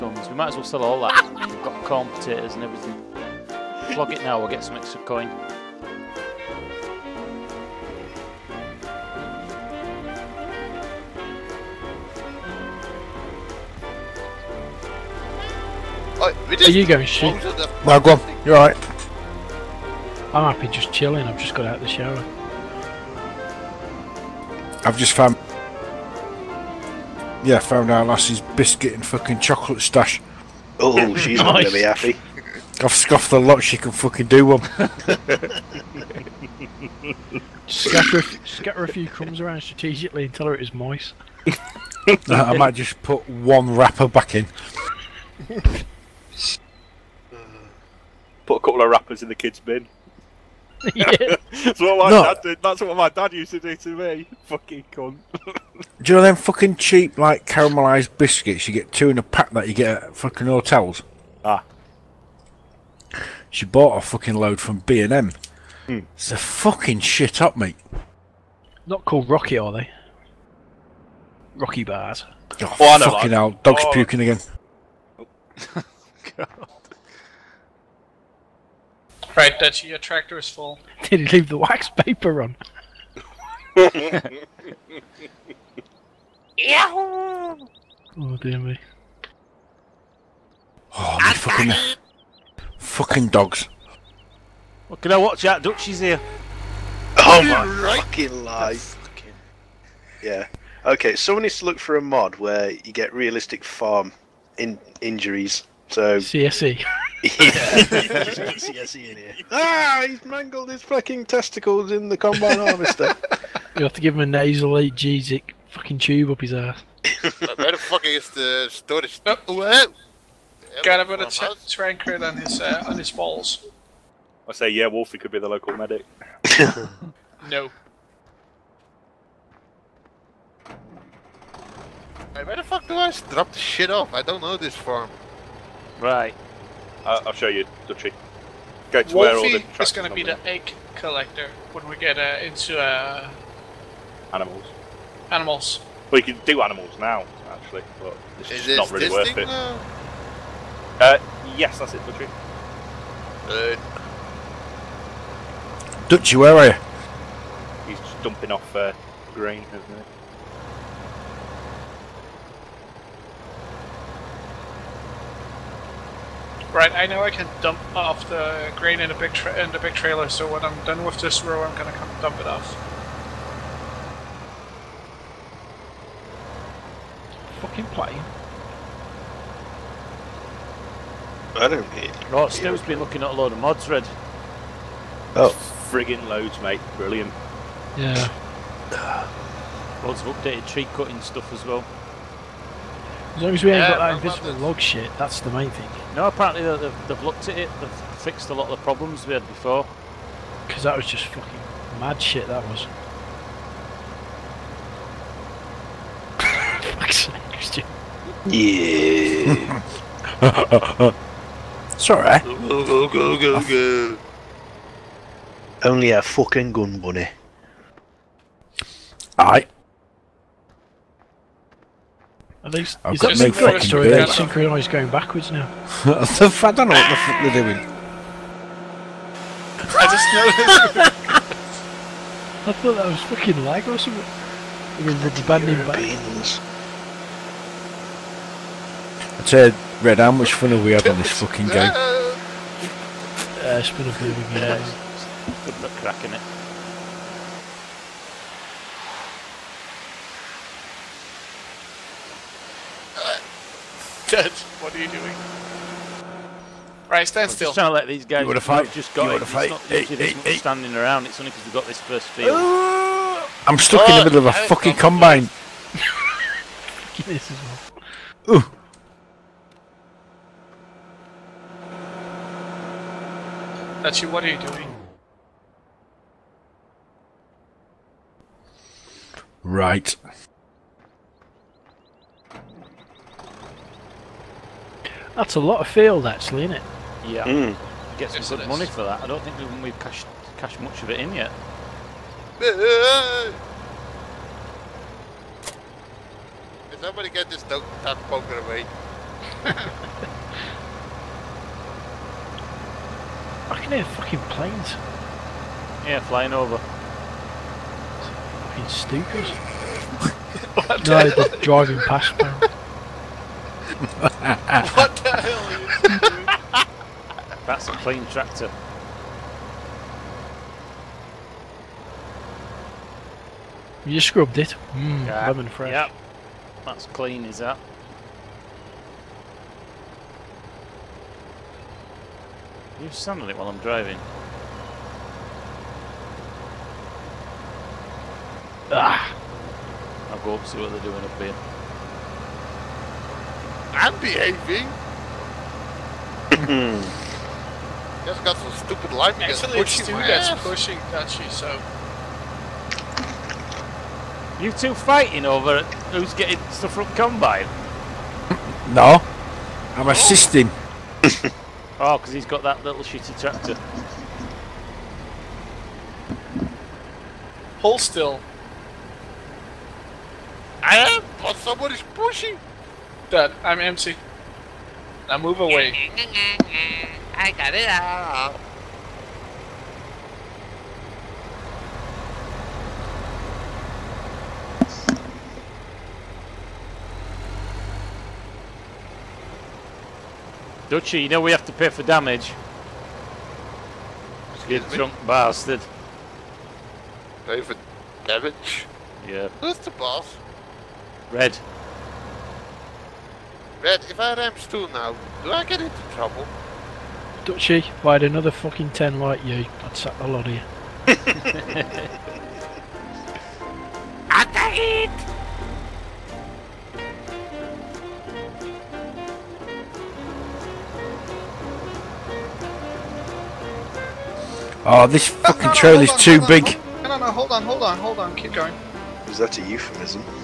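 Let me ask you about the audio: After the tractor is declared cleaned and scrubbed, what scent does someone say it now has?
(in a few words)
Lemon fresh.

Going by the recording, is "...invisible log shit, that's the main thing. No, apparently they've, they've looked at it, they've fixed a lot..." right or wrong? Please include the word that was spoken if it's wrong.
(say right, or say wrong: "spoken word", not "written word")
right.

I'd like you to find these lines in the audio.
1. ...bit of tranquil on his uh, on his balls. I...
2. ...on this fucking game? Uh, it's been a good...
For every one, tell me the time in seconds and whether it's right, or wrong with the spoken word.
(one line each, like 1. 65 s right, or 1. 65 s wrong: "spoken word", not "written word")
1. 121 s right
2. 241 s right.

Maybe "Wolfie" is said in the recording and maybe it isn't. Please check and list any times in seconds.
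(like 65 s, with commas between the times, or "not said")
124 s, 139 s.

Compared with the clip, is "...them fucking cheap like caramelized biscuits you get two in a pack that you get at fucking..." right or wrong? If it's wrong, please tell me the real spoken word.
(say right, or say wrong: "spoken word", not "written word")
right.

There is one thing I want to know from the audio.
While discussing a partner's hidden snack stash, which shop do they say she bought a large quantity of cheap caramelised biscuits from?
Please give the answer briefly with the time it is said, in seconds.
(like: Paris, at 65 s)
B and M, at 64 s.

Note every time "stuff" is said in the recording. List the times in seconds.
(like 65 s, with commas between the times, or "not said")
191 s, 356 s.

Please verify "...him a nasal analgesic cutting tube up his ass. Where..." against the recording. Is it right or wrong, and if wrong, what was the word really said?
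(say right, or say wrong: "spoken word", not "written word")
wrong: "fucking", not "cutting".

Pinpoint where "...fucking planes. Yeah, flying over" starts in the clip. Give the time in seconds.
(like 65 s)
304 s.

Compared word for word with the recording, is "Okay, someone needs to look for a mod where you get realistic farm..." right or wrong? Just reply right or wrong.
right.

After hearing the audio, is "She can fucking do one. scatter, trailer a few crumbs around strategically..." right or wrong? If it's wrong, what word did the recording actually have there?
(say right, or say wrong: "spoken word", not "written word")
wrong: "scatter", not "trailer".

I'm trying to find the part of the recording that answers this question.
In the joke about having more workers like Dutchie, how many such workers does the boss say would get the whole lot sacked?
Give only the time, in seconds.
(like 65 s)
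408 s.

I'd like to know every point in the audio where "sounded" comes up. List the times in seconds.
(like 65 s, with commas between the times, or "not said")
333 s.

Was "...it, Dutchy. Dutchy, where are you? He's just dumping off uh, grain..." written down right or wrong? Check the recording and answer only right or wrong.
right.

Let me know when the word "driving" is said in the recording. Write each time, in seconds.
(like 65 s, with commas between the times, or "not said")
311 s, 333 s.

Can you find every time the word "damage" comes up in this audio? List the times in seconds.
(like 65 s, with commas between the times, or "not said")
392 s, 398 s.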